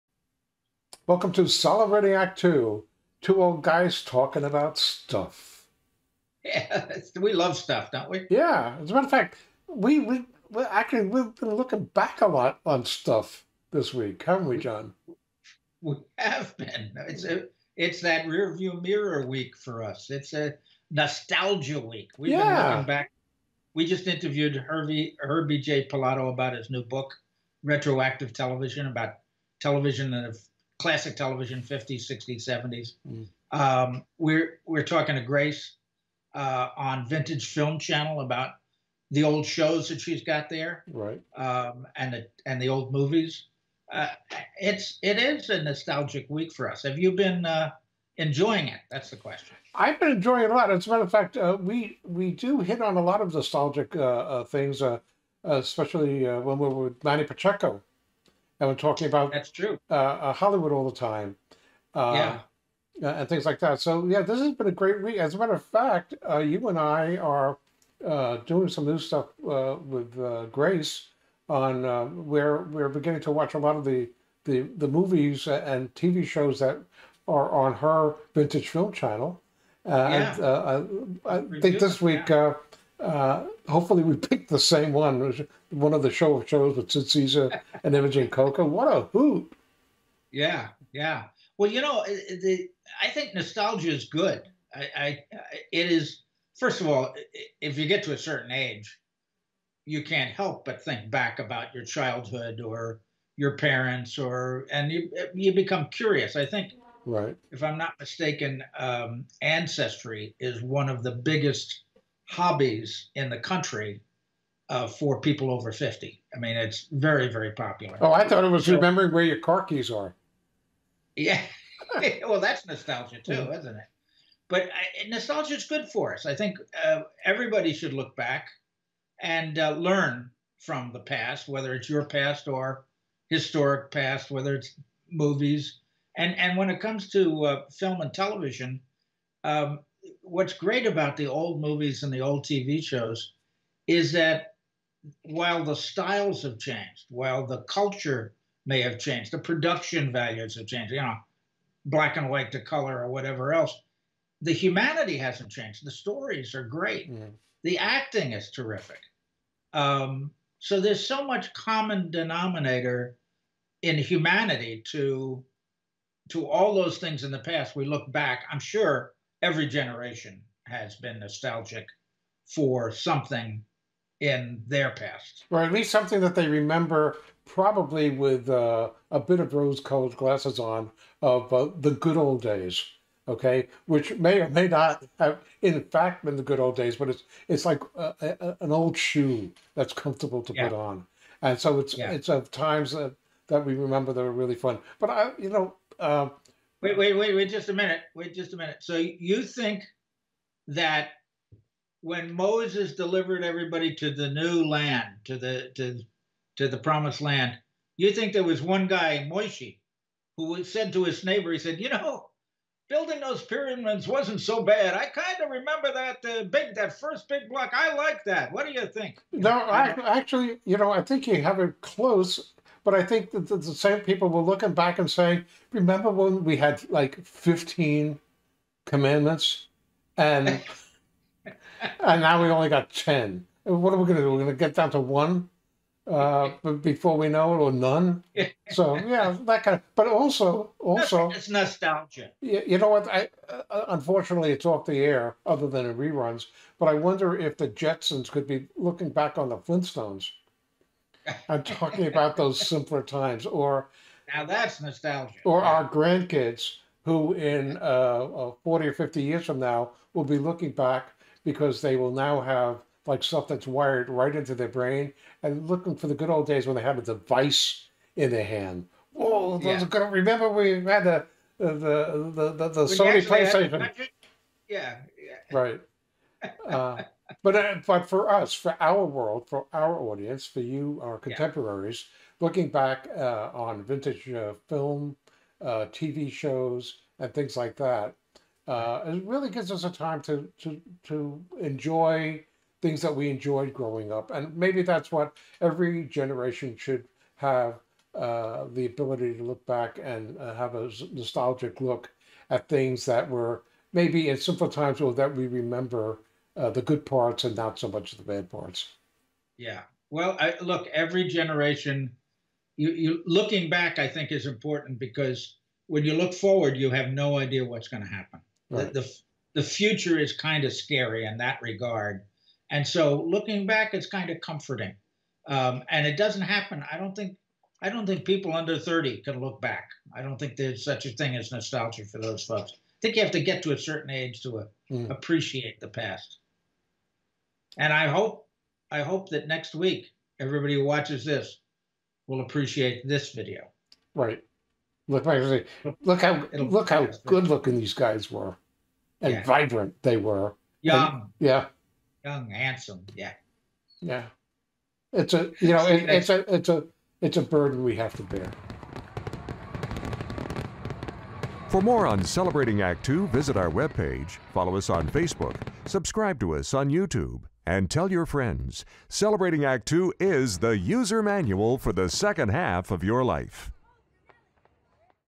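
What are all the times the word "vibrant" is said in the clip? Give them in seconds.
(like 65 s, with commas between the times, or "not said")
349 s.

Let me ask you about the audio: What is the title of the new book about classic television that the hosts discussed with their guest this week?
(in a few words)
Retroactive Television.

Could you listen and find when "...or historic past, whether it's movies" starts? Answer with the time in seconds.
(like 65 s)
132 s.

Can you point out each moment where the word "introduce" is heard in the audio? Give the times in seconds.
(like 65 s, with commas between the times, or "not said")
not said.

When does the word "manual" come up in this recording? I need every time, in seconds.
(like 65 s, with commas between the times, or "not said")
371 s.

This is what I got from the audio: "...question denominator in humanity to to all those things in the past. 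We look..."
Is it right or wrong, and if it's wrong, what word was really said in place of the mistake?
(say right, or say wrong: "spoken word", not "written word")
wrong: "common", not "question".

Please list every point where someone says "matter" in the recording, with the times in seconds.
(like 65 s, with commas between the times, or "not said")
8 s, 50 s, 65 s.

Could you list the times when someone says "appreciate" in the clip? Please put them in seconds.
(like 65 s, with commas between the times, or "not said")
335 s, 342 s.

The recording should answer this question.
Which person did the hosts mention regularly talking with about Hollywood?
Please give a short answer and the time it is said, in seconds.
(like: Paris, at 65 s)
Manny Pacheco, at 57 s.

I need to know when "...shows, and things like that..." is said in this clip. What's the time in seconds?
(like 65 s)
286 s.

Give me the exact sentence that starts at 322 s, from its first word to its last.
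And so looking back, it's kind of comforting.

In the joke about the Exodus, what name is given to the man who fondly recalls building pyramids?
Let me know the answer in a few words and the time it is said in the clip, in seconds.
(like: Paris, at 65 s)
Moishi, at 209 s.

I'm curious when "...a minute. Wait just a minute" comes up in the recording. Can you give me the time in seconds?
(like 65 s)
197 s.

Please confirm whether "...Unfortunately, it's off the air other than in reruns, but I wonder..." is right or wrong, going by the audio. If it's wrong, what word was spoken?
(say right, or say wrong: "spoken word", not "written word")
right.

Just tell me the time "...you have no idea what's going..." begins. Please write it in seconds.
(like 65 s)
316 s.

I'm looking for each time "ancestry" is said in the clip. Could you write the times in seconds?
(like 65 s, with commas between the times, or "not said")
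109 s.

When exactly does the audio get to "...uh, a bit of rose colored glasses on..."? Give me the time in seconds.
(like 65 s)
178 s.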